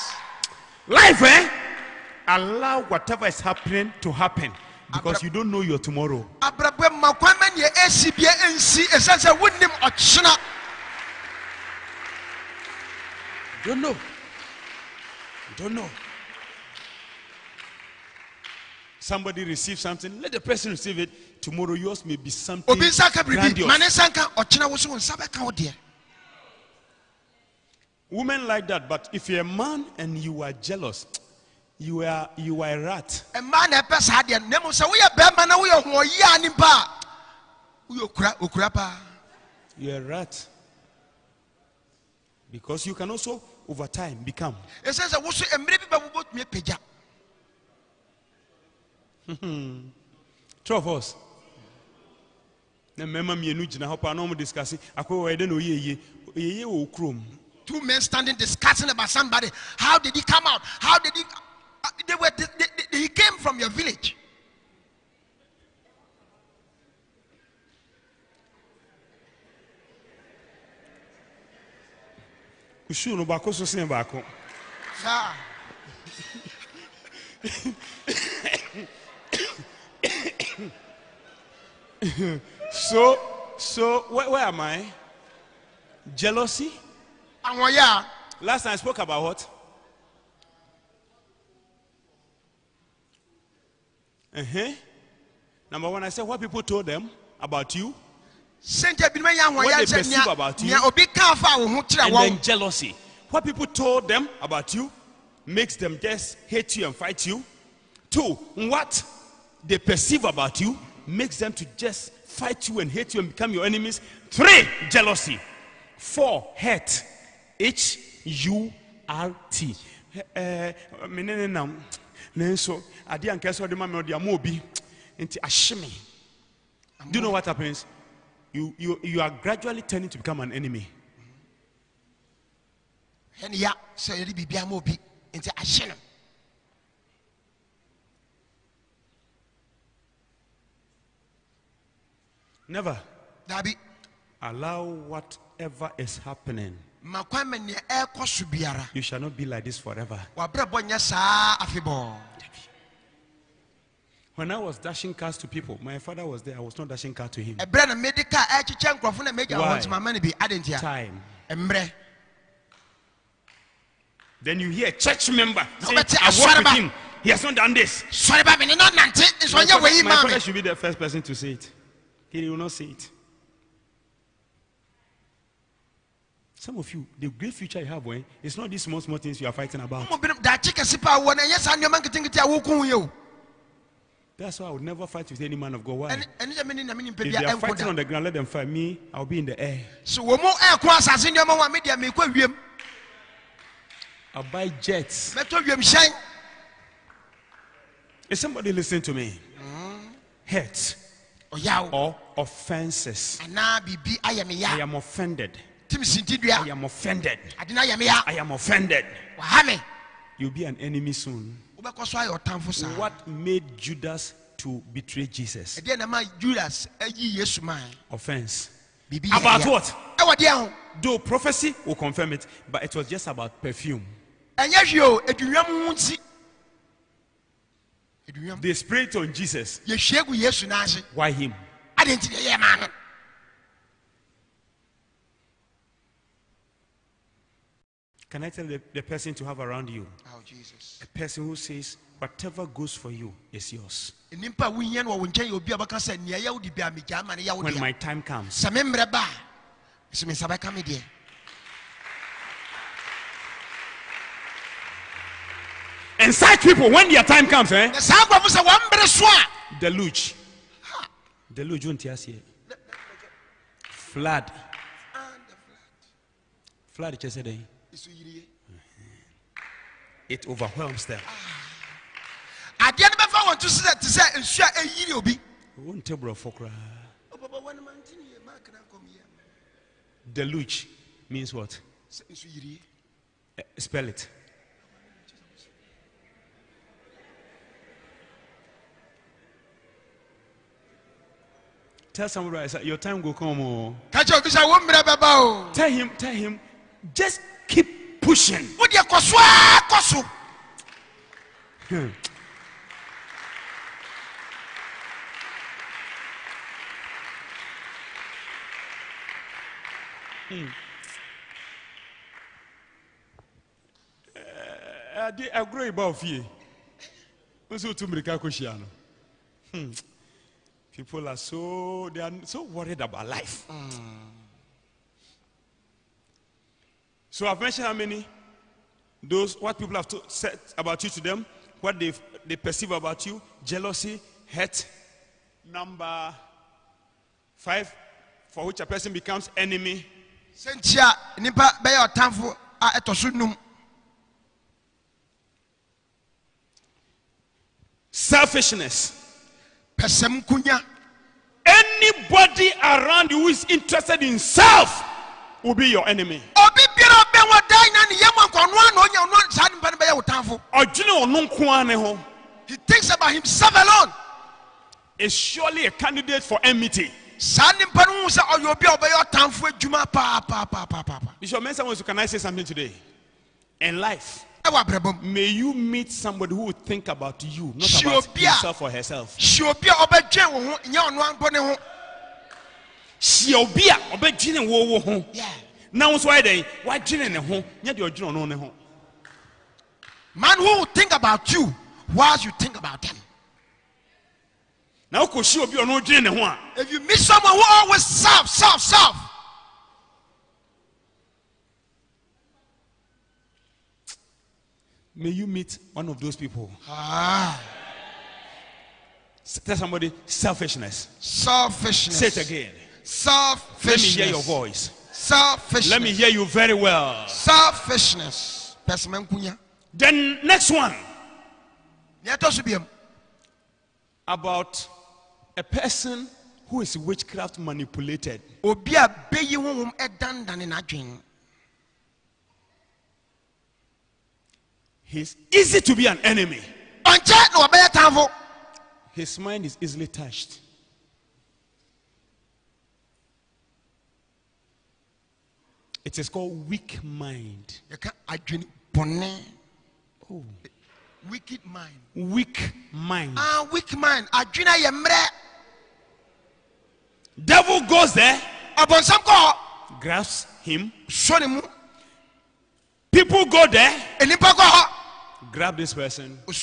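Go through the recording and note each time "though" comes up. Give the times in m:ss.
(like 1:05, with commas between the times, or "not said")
3:41.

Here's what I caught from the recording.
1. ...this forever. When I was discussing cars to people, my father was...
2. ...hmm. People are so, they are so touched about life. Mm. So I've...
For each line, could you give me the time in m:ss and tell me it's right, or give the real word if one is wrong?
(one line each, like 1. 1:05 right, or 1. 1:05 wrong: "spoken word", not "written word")
1. 2:29 wrong: "dashing", not "discussing"
2. 5:19 wrong: "worried", not "touched".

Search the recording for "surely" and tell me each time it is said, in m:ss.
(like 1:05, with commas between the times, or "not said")
6:05.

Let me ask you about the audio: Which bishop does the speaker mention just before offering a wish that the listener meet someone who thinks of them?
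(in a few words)
Bishop Mensah.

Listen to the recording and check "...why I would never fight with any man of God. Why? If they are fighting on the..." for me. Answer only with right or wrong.
right.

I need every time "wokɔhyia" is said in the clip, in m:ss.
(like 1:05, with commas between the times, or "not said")
6:35.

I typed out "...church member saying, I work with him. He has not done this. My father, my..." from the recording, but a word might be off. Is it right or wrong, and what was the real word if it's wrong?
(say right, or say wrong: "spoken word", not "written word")
right.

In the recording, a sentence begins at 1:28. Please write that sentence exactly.
Last time I spoke about what?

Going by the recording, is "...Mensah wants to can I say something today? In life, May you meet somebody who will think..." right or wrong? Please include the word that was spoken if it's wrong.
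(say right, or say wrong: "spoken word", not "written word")
right.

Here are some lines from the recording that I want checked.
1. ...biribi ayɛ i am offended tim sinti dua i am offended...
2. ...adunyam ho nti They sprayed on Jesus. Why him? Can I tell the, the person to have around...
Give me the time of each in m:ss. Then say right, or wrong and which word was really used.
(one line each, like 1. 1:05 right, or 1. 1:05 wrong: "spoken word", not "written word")
1. 3:23 right
2. 3:45 right.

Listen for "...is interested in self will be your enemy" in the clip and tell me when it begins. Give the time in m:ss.
5:53.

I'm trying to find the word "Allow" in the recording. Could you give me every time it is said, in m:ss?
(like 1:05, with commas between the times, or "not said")
0:02, 2:24.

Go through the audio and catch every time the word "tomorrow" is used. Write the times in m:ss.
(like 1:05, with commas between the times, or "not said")
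0:05, 0:21.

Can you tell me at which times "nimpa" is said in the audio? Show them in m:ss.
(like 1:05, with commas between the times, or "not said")
0:36.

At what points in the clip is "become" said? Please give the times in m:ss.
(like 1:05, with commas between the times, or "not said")
0:44, 1:53, 2:10, 5:39.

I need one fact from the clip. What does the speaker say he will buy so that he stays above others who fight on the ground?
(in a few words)
jets.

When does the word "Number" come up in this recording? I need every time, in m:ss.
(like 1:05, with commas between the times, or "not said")
1:35, 5:35.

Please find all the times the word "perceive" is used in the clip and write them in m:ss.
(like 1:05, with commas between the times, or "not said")
1:39, 1:49, 5:32.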